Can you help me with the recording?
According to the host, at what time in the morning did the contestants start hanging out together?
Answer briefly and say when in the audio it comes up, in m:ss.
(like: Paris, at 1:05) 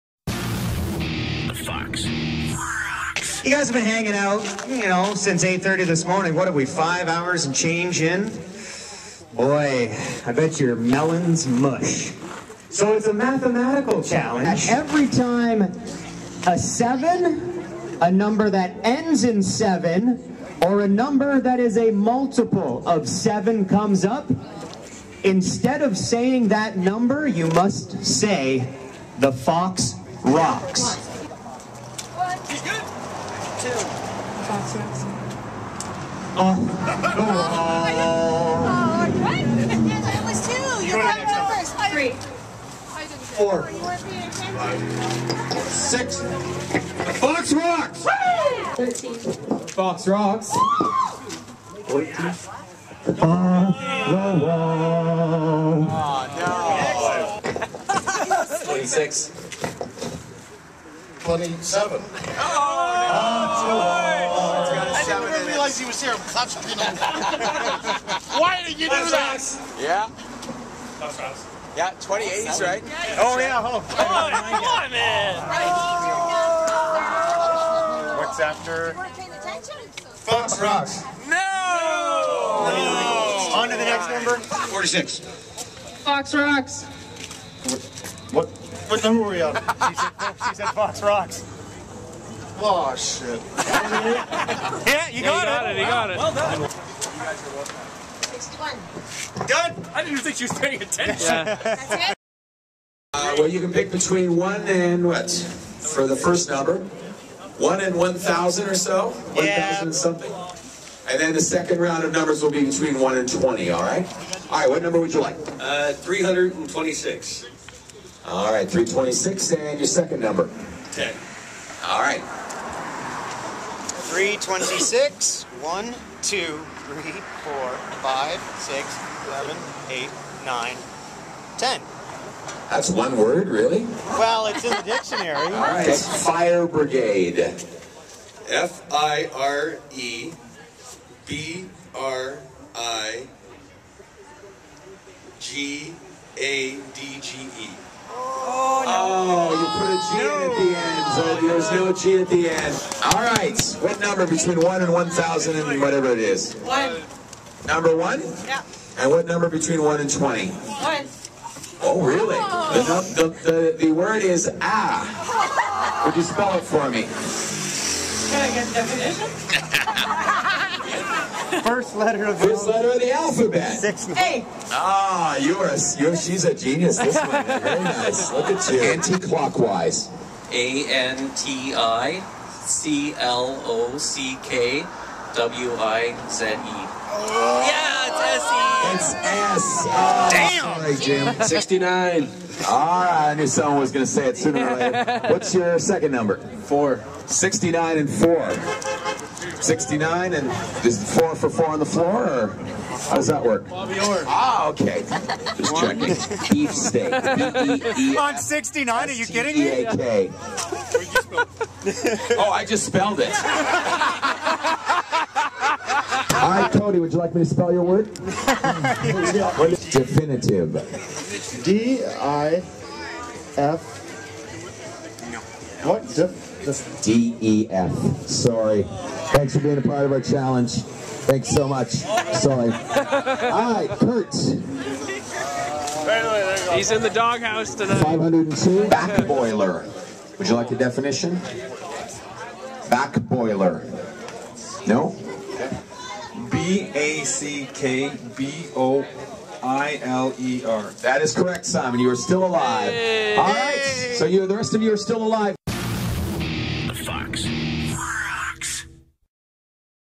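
8:30, at 0:05.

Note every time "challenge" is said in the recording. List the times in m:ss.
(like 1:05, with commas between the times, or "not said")
0:14, 3:50.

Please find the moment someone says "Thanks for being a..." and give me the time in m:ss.
3:49.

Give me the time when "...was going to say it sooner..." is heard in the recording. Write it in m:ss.
3:13.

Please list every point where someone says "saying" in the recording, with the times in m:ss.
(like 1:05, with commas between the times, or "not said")
0:25.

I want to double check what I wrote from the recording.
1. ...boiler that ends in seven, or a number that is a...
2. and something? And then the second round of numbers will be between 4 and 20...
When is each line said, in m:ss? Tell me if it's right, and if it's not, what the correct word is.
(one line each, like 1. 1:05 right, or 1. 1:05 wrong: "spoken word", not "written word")
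1. 0:18 wrong: "number", not "boiler"
2. 1:49 wrong: "1", not "4".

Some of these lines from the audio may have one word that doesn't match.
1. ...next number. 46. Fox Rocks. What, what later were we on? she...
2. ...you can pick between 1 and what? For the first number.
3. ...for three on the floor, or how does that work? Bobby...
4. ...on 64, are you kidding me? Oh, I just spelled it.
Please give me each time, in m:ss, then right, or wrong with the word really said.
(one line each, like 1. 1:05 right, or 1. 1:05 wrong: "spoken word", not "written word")
1. 1:23 wrong: "number", not "later"
2. 1:43 right
3. 3:21 wrong: "four", not "three"
4. 3:28 wrong: "69", not "64".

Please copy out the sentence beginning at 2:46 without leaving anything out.
Would you spell it for me?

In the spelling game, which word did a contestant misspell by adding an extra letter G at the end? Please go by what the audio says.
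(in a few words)
fire brigade.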